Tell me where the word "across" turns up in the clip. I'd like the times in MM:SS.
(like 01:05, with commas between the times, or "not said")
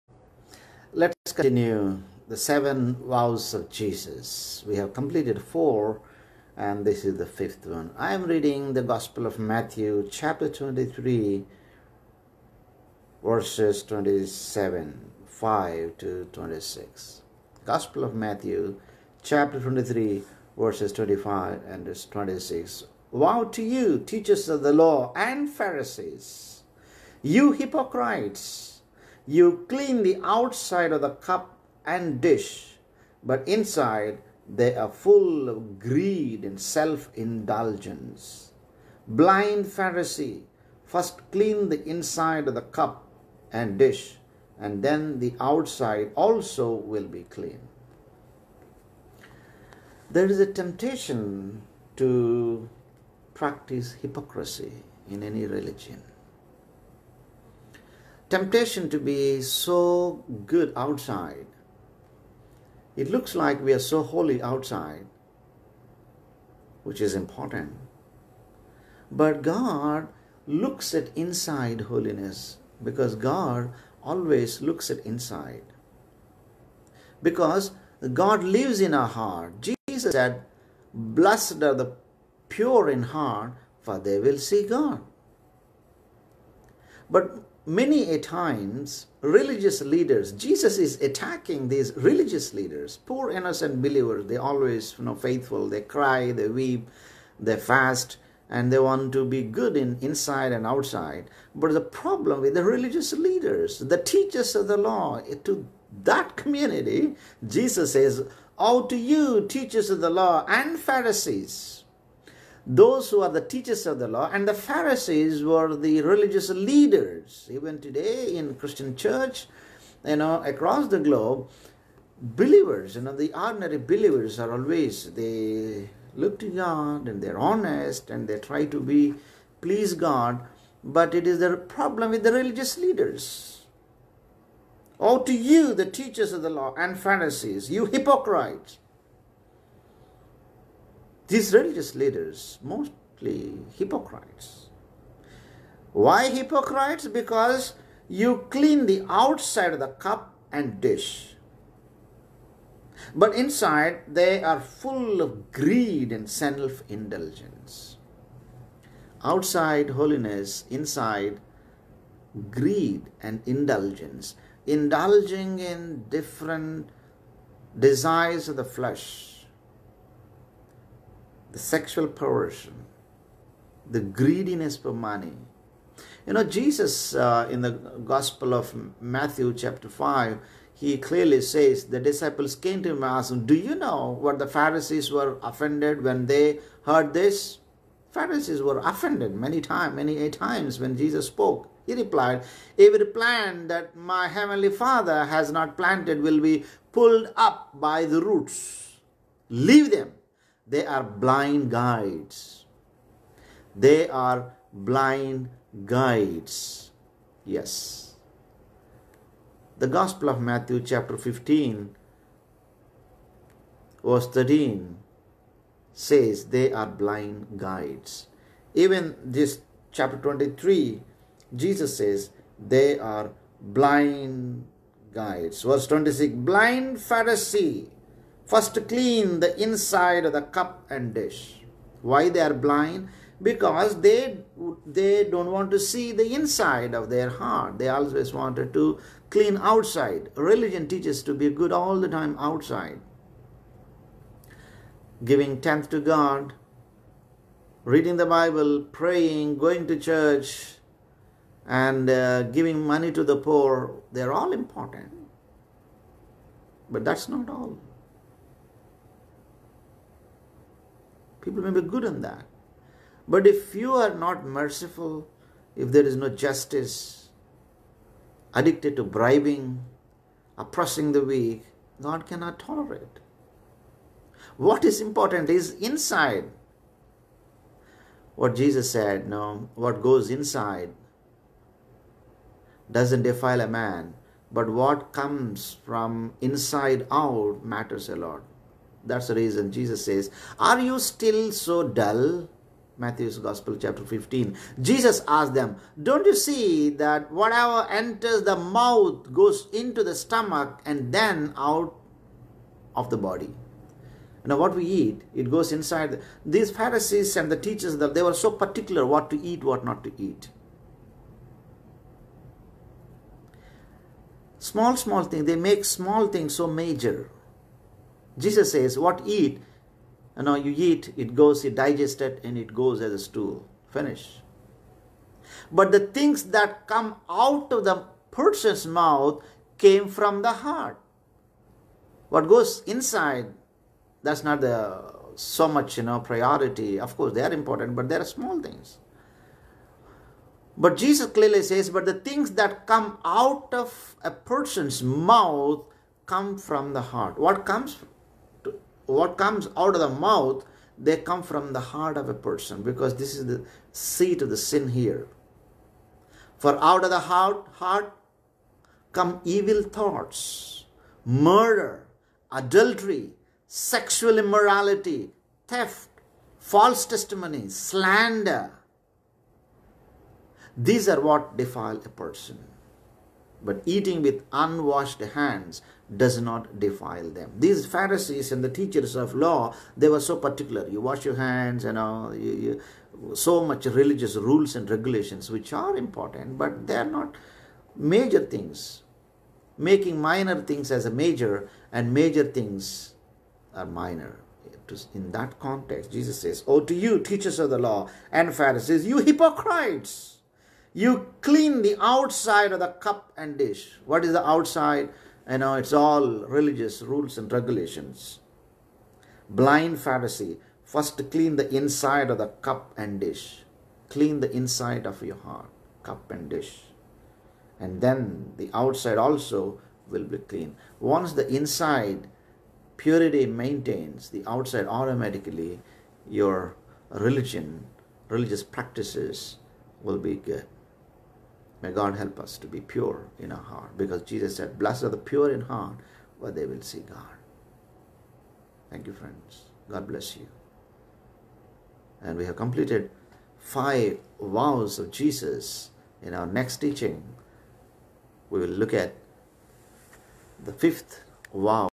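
02:00.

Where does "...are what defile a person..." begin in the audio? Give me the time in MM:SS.
06:11.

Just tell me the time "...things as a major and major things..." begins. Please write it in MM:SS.
06:30.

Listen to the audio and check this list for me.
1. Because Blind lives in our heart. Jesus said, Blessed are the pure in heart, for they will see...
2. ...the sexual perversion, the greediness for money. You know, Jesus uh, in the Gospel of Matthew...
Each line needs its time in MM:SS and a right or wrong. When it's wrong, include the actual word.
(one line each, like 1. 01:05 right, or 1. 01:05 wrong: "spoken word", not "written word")
1. 01:17 wrong: "God", not "Blind"
2. 02:51 right.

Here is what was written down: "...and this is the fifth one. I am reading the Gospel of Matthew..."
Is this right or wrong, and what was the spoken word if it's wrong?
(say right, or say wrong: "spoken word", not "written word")
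right.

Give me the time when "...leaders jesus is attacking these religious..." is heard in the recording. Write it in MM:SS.
01:29.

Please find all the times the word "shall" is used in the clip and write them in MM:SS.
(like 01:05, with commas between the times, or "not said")
not said.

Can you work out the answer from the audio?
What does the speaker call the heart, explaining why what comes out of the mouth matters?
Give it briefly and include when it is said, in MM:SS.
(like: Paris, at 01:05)
the seat of the sin, at 05:53.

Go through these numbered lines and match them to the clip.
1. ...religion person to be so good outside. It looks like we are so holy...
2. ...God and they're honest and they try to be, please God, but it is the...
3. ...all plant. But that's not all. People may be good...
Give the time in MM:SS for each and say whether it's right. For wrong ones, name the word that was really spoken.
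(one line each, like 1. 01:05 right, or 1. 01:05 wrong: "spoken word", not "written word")
1. 00:55 wrong: "temptation", not "person"
2. 02:06 right
3. 04:14 wrong: "important", not "plant".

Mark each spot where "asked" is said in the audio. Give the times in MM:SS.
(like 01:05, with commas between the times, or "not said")
03:03, 04:55.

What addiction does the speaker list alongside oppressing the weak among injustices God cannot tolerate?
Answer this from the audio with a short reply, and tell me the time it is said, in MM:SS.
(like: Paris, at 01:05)
bribing, at 04:28.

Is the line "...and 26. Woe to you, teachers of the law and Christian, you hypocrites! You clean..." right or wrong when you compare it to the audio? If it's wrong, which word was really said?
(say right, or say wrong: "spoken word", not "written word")
wrong: "Pharisees", not "Christian".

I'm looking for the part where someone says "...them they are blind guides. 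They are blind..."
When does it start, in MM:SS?
03:19.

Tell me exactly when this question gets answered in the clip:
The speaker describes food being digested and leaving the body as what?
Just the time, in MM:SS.
05:23.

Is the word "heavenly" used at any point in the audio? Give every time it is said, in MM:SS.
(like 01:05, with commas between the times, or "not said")
03:14.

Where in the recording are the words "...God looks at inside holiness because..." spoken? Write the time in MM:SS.
01:09.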